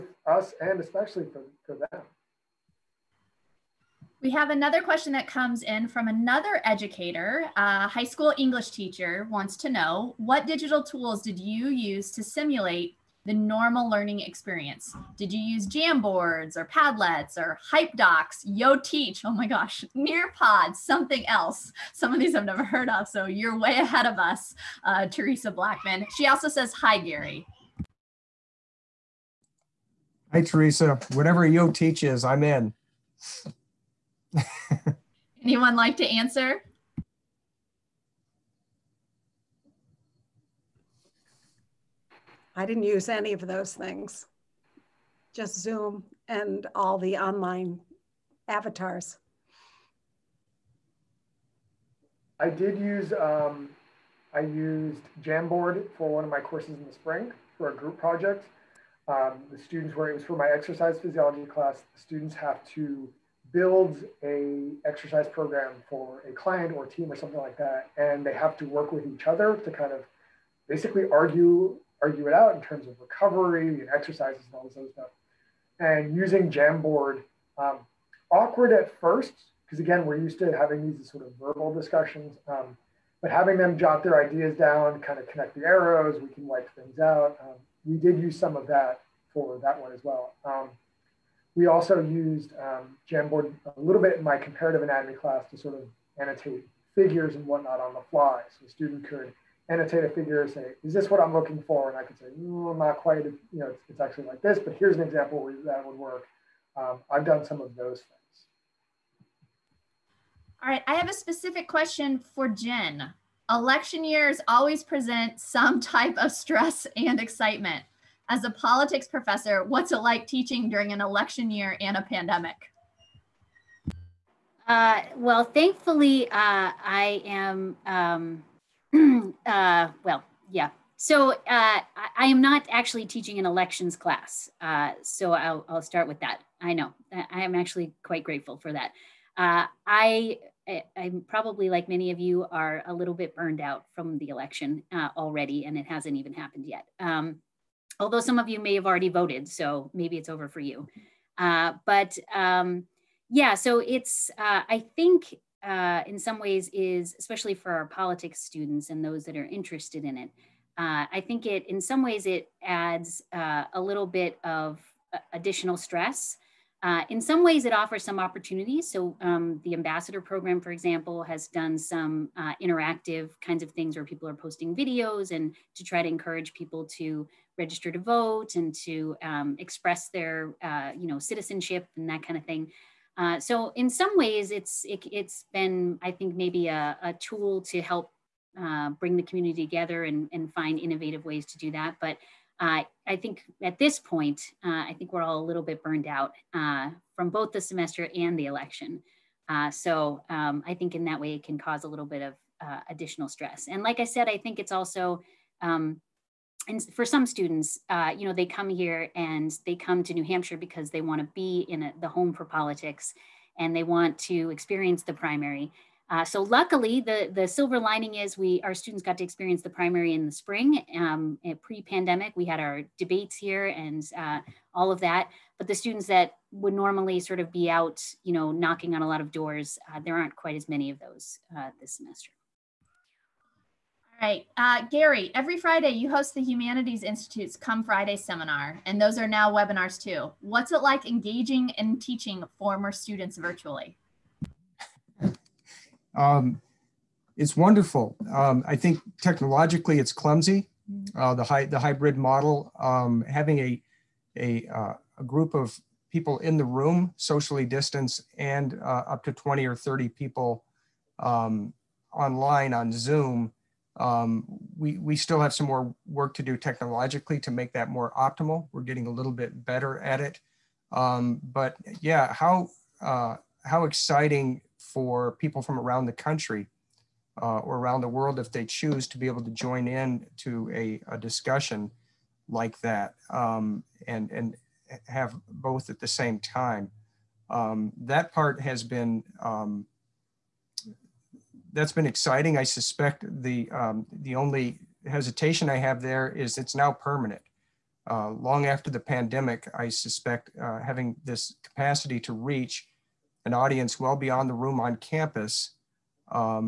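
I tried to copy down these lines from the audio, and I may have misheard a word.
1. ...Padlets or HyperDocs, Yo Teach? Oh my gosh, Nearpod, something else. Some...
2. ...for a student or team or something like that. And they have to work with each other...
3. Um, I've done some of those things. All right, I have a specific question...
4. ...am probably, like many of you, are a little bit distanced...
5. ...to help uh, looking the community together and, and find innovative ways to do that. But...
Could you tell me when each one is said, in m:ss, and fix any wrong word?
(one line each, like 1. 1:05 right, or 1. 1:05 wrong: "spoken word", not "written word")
1. 0:16 right
2. 1:05 wrong: "client", not "student"
3. 1:46 right
4. 2:20 wrong: "burned", not "distanced"
5. 3:07 wrong: "bring", not "looking".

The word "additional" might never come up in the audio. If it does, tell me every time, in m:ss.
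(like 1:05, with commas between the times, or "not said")
2:45, 3:22.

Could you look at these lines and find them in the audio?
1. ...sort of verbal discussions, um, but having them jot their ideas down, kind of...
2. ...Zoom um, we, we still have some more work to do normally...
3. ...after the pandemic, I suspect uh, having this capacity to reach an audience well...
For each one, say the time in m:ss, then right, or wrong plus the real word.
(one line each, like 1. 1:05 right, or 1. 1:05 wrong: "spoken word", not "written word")
1. 1:21 right
2. 4:22 wrong: "technologically", not "normally"
3. 4:58 right.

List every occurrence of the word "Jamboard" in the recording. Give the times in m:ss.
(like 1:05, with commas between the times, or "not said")
0:15, 0:55, 1:16, 1:33.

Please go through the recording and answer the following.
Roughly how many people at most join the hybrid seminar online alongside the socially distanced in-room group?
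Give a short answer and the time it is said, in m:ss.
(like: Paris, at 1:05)
20 or 30, at 4:19.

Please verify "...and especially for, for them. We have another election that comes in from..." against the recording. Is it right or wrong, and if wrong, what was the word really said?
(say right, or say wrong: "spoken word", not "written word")
wrong: "question", not "election".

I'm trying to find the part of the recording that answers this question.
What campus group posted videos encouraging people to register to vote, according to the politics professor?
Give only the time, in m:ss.
2:49.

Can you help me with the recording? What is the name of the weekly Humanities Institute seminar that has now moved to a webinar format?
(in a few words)
Come Friday.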